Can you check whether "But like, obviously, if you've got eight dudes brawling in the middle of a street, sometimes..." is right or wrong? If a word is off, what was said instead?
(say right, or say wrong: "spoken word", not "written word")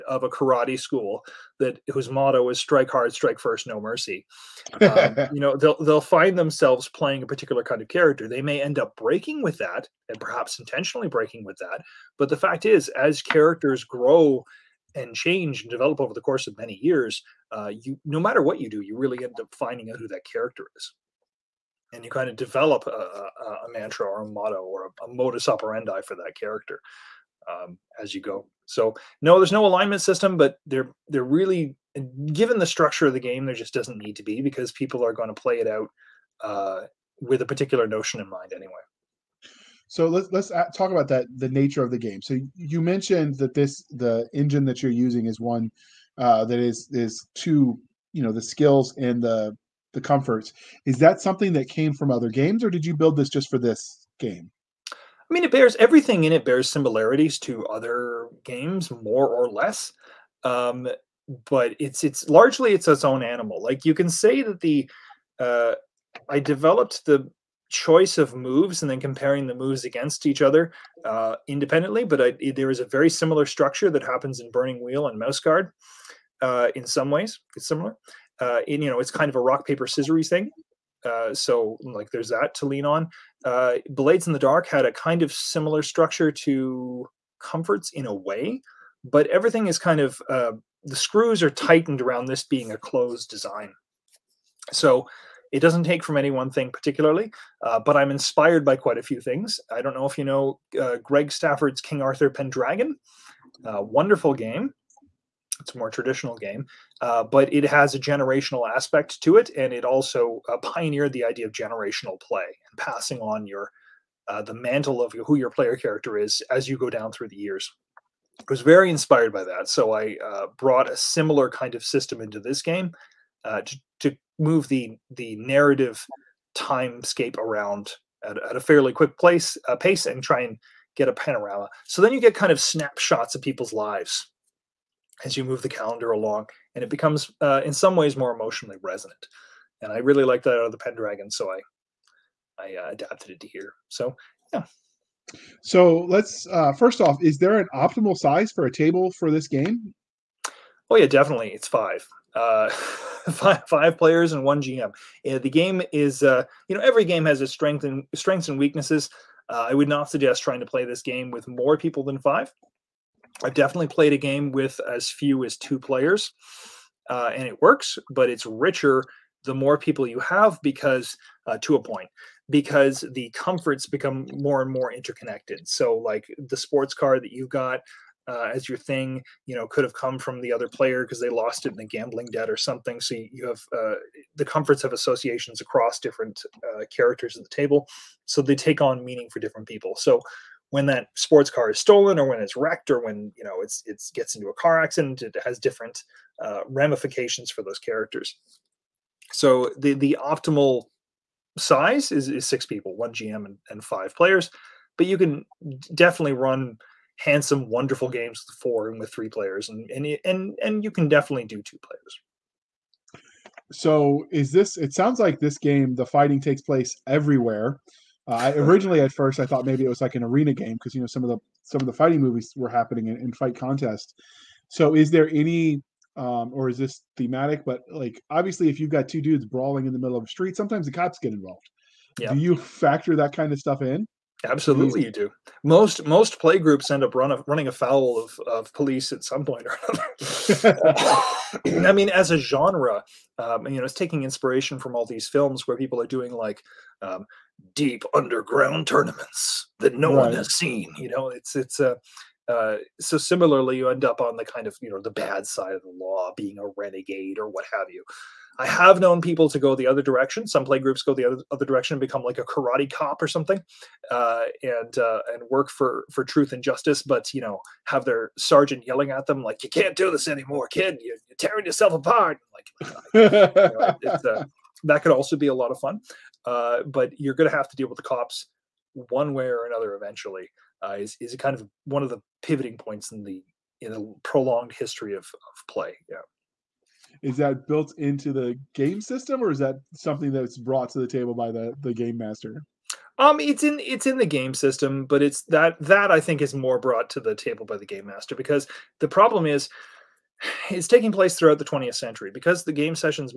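wrong: "two", not "eight".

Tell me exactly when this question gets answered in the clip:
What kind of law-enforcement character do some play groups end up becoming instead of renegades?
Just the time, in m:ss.
4:22.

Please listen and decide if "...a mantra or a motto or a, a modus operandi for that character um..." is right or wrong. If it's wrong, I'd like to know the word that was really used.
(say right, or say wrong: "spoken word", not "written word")
right.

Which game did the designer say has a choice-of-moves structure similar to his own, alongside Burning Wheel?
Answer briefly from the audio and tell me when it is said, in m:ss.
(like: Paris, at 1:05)
Mouse Guard, at 1:15.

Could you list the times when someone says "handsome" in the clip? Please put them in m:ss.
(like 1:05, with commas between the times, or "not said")
3:27.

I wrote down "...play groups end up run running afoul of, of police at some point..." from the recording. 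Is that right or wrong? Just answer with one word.
right.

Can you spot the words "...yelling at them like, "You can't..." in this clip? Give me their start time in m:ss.
4:28.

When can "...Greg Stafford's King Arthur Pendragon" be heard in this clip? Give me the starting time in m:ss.
1:41.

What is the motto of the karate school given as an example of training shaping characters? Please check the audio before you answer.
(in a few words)
Strike hard, strike first, no mercy.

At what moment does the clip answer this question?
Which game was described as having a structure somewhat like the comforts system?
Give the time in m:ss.
1:23.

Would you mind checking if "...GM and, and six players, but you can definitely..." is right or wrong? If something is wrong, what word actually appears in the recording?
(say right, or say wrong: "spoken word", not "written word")
wrong: "five", not "six".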